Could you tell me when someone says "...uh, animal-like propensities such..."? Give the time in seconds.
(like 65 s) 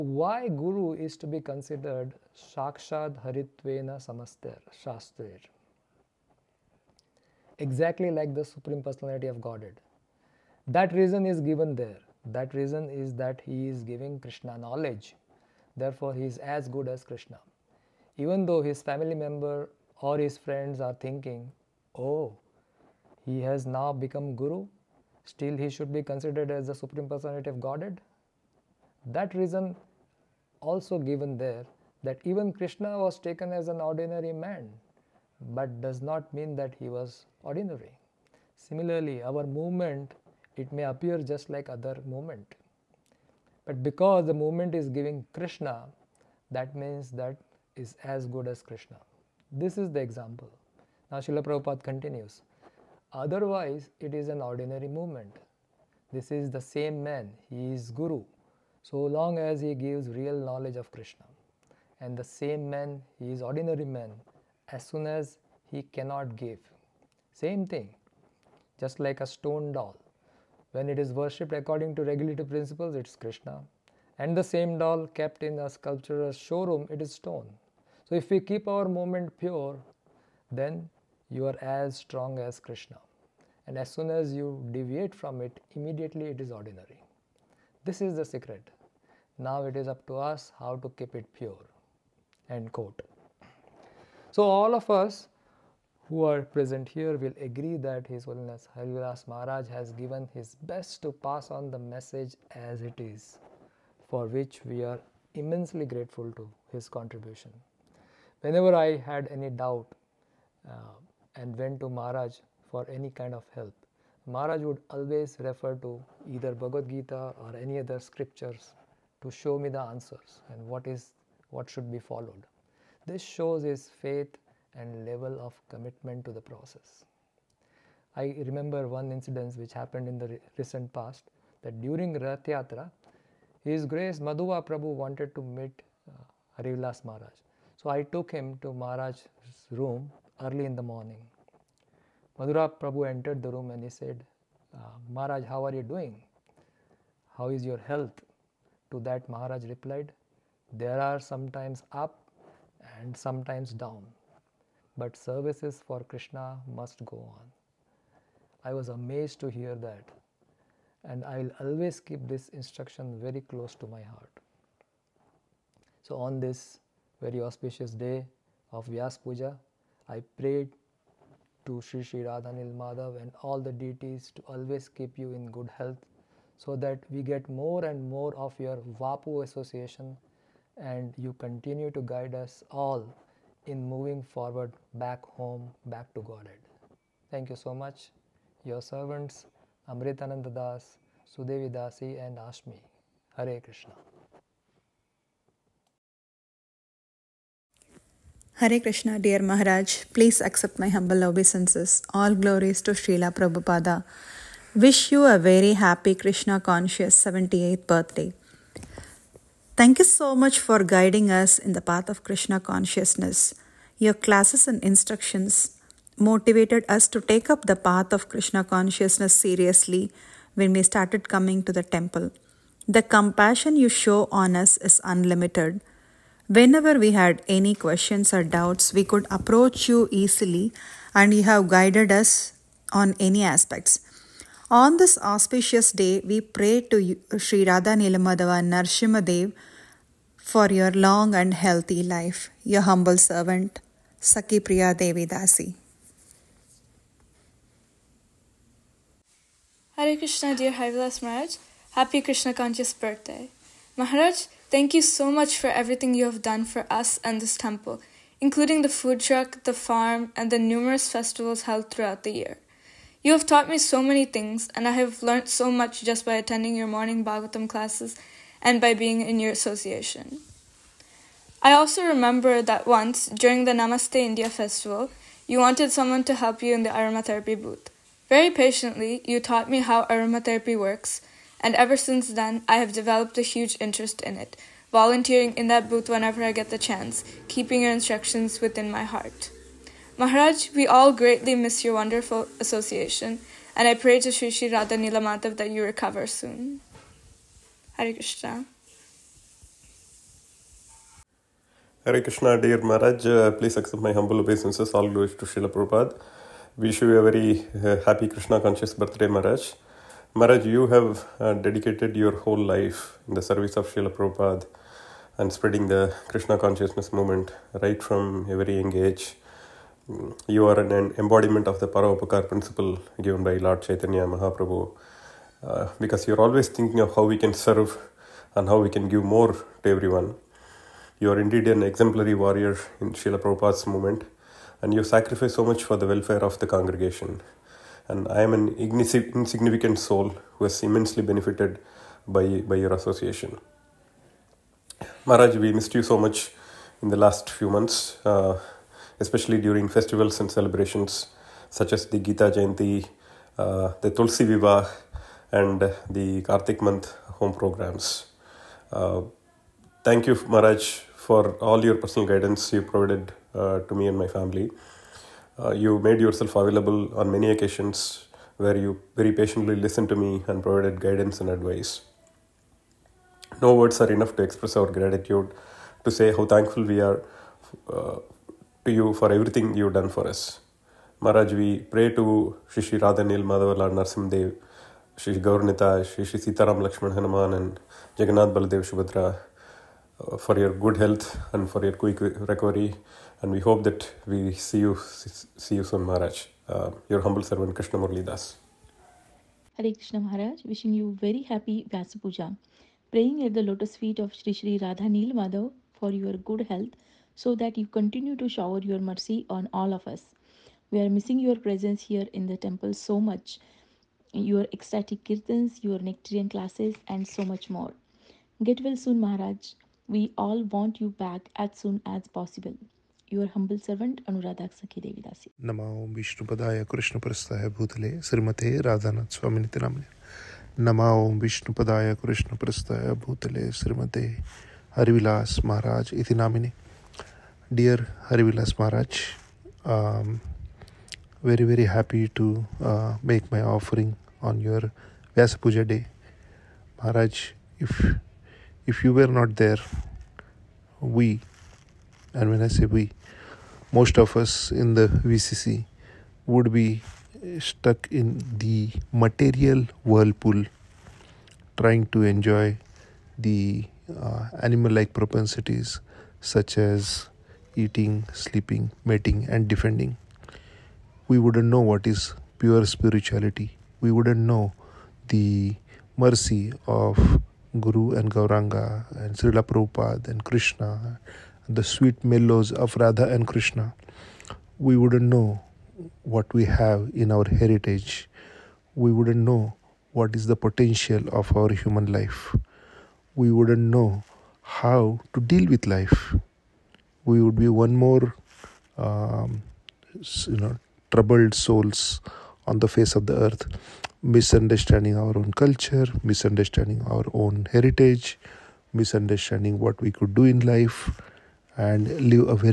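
464 s.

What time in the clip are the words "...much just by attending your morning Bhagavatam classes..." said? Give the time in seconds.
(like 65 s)
265 s.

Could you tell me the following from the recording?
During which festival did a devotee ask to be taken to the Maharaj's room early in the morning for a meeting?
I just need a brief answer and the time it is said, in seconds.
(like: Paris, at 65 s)
Rath Yatra, at 132 s.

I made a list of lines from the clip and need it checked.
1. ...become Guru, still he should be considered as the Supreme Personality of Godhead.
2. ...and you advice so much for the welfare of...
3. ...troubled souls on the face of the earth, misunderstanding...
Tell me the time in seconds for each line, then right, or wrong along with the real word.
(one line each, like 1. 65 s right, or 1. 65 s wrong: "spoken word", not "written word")
1. 23 s right
2. 334 s wrong: "sacrifice", not "advice"
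3. 501 s right.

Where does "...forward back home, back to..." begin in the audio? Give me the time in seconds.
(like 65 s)
184 s.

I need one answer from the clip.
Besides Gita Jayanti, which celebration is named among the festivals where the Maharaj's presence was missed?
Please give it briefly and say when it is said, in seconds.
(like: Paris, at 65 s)
Tulsi Vivah, at 354 s.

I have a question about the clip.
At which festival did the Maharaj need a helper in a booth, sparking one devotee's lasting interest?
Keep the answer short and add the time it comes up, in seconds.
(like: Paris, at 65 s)
Namaste India, at 273 s.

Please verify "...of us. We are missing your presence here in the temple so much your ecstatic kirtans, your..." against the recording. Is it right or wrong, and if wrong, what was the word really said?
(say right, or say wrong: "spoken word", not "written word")
right.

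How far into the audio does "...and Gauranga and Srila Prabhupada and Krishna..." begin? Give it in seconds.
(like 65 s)
478 s.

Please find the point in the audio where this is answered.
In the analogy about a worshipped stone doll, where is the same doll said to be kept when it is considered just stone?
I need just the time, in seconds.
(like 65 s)
75 s.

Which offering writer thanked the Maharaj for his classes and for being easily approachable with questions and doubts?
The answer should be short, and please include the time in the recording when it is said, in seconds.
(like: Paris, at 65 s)
Saki Priya Devi Dasi, at 244 s.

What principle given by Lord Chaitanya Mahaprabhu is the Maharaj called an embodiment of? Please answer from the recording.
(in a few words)
Paravopacar.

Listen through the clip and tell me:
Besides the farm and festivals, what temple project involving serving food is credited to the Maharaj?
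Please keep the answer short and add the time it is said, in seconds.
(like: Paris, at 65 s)
Food truck, at 258 s.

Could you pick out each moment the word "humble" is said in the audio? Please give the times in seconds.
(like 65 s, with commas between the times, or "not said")
200 s, 242 s, 304 s, 397 s, 423 s.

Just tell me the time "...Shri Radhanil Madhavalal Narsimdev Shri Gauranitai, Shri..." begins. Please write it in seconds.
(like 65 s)
382 s.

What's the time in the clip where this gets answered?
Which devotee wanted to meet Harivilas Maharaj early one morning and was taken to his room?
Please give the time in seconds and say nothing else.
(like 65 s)
134 s.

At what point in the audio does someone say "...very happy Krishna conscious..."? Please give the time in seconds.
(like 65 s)
205 s.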